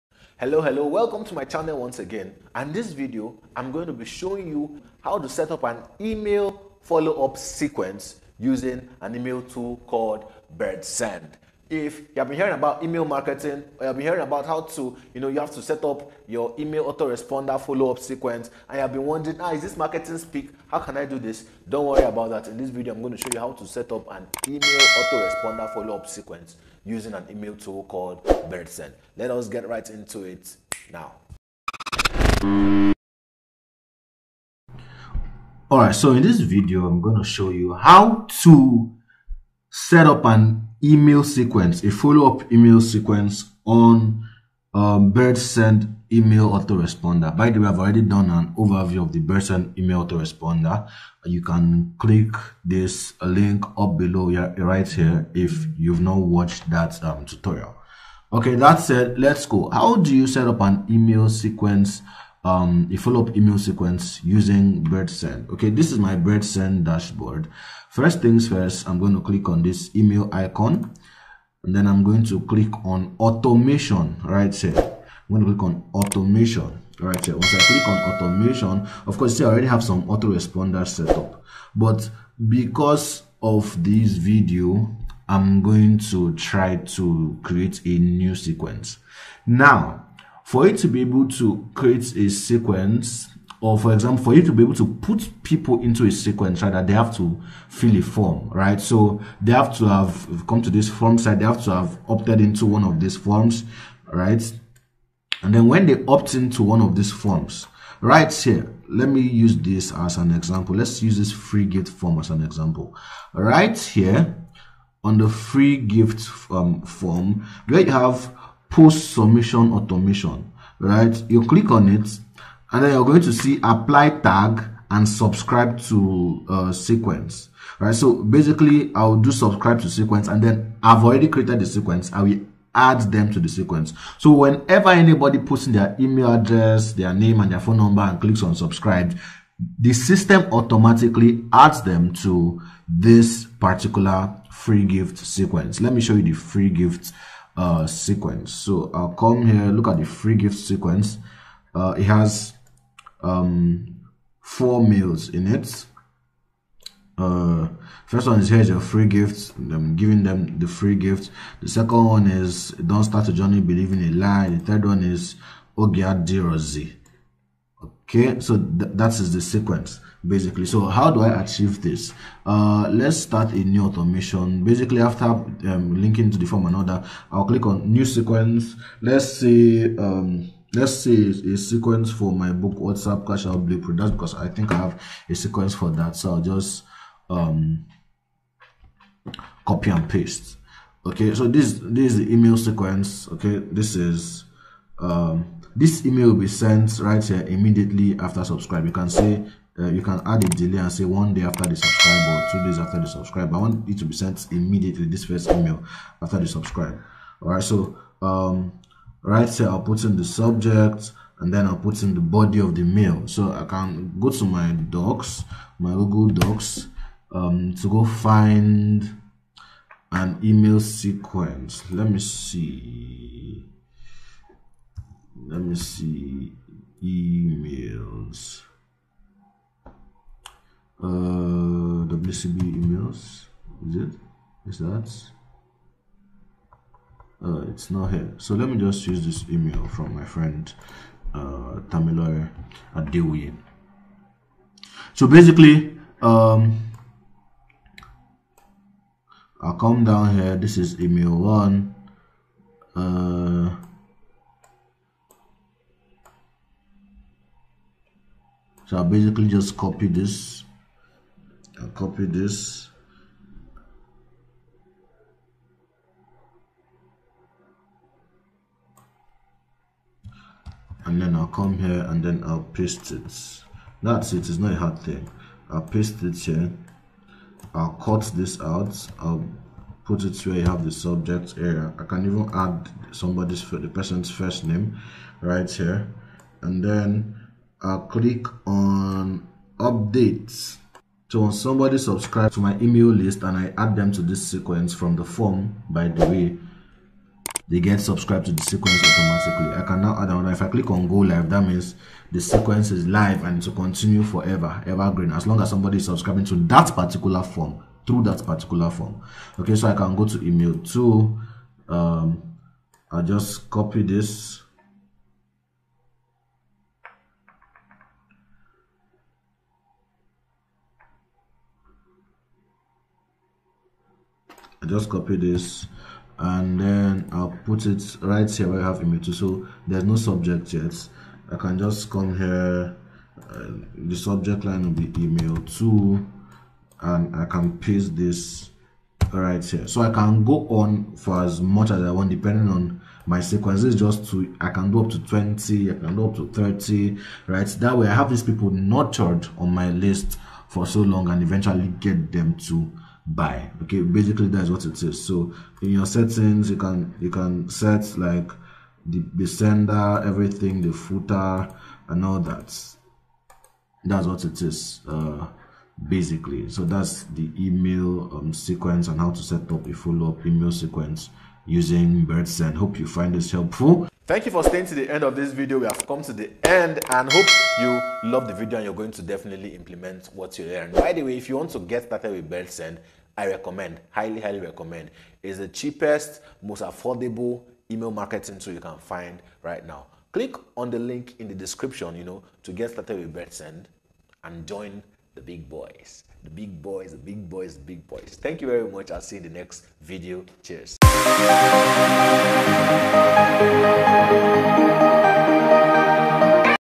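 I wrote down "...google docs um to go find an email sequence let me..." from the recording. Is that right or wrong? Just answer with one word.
right.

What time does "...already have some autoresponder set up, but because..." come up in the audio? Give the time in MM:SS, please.
01:19.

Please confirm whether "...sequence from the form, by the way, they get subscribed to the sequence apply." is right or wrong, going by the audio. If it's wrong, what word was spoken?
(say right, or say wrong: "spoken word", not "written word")
wrong: "automatically", not "apply".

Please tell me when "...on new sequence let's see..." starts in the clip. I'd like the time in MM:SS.
02:57.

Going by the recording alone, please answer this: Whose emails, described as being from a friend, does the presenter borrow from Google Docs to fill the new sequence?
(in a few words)
Tamilor.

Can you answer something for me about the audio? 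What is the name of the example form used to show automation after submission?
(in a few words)
free gift form.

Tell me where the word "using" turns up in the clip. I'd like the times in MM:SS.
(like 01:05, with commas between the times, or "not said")
00:08, 00:26, 01:04, 06:11.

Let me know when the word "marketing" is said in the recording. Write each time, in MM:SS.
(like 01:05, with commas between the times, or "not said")
00:13, 00:19, 06:28.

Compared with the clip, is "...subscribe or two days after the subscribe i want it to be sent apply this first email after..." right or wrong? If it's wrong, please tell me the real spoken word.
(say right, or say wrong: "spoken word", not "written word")
wrong: "immediately", not "apply".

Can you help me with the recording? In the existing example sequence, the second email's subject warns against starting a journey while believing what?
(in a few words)
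a lie.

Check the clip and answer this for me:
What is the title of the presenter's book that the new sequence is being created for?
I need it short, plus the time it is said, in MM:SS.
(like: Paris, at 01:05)
WhatsApp Cash Out Blueprint, at 03:02.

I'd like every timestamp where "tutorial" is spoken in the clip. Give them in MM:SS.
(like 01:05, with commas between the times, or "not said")
00:57.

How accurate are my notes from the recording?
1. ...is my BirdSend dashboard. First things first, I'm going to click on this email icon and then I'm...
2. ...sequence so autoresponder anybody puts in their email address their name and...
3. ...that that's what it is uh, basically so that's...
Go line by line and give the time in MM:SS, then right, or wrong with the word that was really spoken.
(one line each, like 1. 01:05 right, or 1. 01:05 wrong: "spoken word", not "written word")
1. 01:05 right
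2. 02:13 wrong: "whenever", not "autoresponder"
3. 06:02 right.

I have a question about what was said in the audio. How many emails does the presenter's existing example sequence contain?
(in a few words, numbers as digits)
4.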